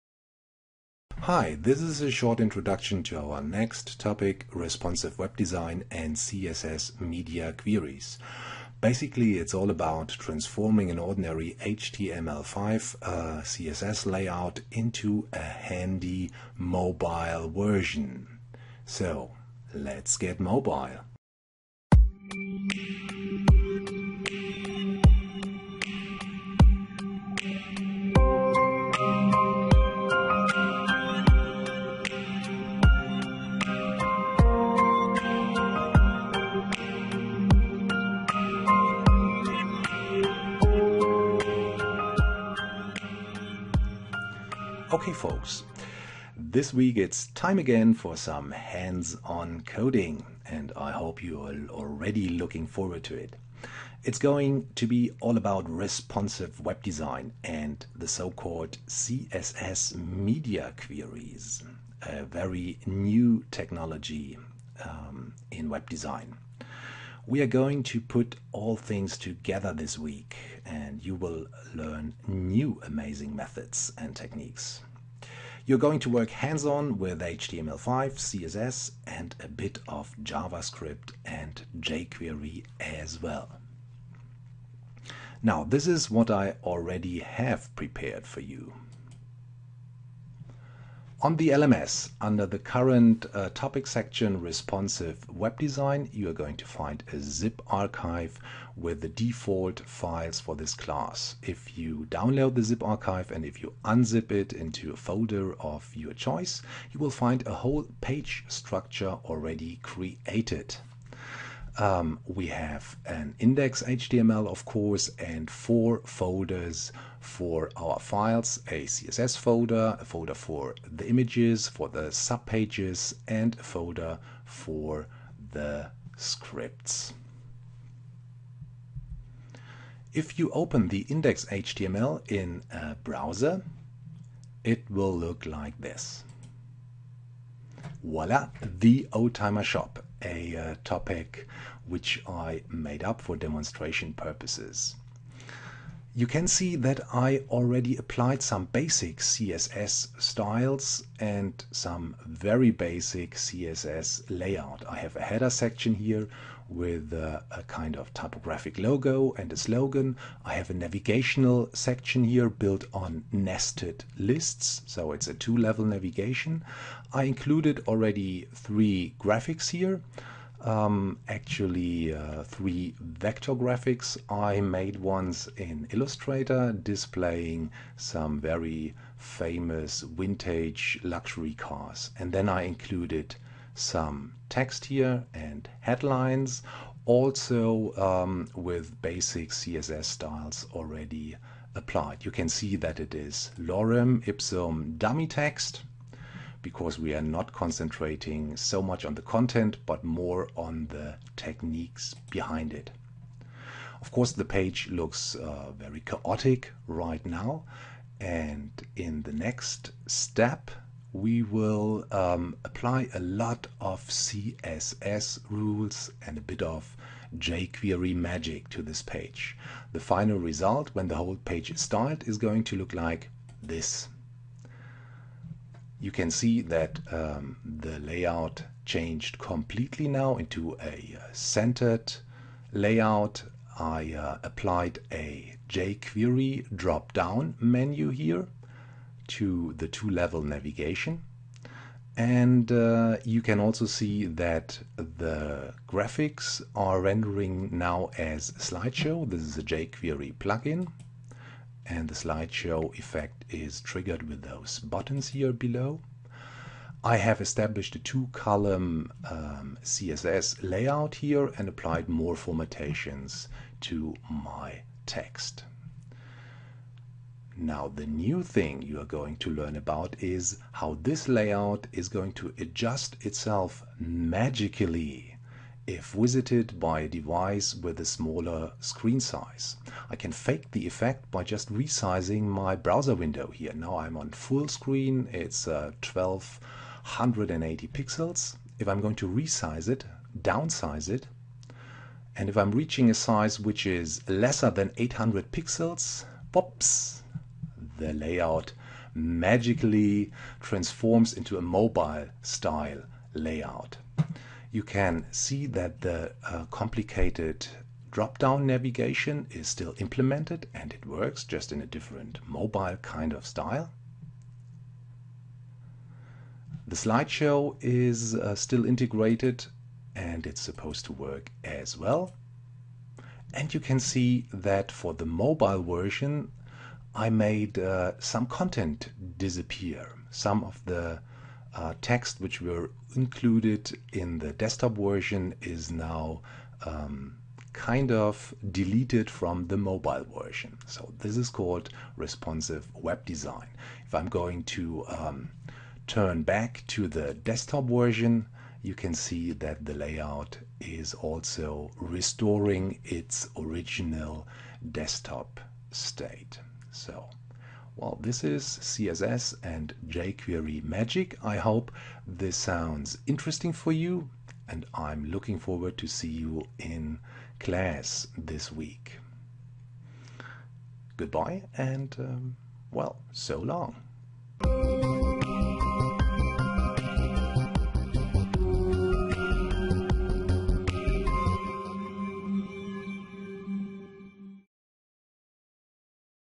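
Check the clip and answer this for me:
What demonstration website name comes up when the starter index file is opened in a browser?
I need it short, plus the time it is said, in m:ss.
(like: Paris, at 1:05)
Oldtimer Shop, at 2:19.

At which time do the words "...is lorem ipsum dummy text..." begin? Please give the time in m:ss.
3:13.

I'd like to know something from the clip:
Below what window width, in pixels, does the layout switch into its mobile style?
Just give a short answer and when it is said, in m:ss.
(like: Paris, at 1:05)
800, at 4:54.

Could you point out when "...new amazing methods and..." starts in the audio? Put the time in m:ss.
1:12.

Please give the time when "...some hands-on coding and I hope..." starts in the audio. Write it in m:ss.
0:48.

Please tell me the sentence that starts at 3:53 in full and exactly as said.
I uh, applied a jQuery drop-down menu here to the two-level navigation.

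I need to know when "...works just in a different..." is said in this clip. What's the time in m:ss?
5:11.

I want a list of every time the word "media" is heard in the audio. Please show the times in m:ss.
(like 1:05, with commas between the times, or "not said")
0:06, 0:59.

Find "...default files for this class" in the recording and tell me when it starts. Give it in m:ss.
1:39.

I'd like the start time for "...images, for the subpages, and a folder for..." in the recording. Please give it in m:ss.
2:01.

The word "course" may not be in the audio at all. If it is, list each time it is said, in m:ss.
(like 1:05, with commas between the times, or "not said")
1:54, 3:24.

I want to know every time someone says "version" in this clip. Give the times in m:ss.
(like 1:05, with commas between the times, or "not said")
0:17, 5:25, 5:34, 5:40, 5:47.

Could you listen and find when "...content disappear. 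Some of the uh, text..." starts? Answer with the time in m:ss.
5:28.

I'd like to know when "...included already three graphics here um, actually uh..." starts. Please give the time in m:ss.
2:47.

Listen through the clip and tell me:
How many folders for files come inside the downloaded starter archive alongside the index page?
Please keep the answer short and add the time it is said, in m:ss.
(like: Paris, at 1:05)
4, at 1:55.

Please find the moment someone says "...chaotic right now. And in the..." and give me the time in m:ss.
3:26.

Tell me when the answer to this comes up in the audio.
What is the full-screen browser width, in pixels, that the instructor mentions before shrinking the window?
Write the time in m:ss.
4:46.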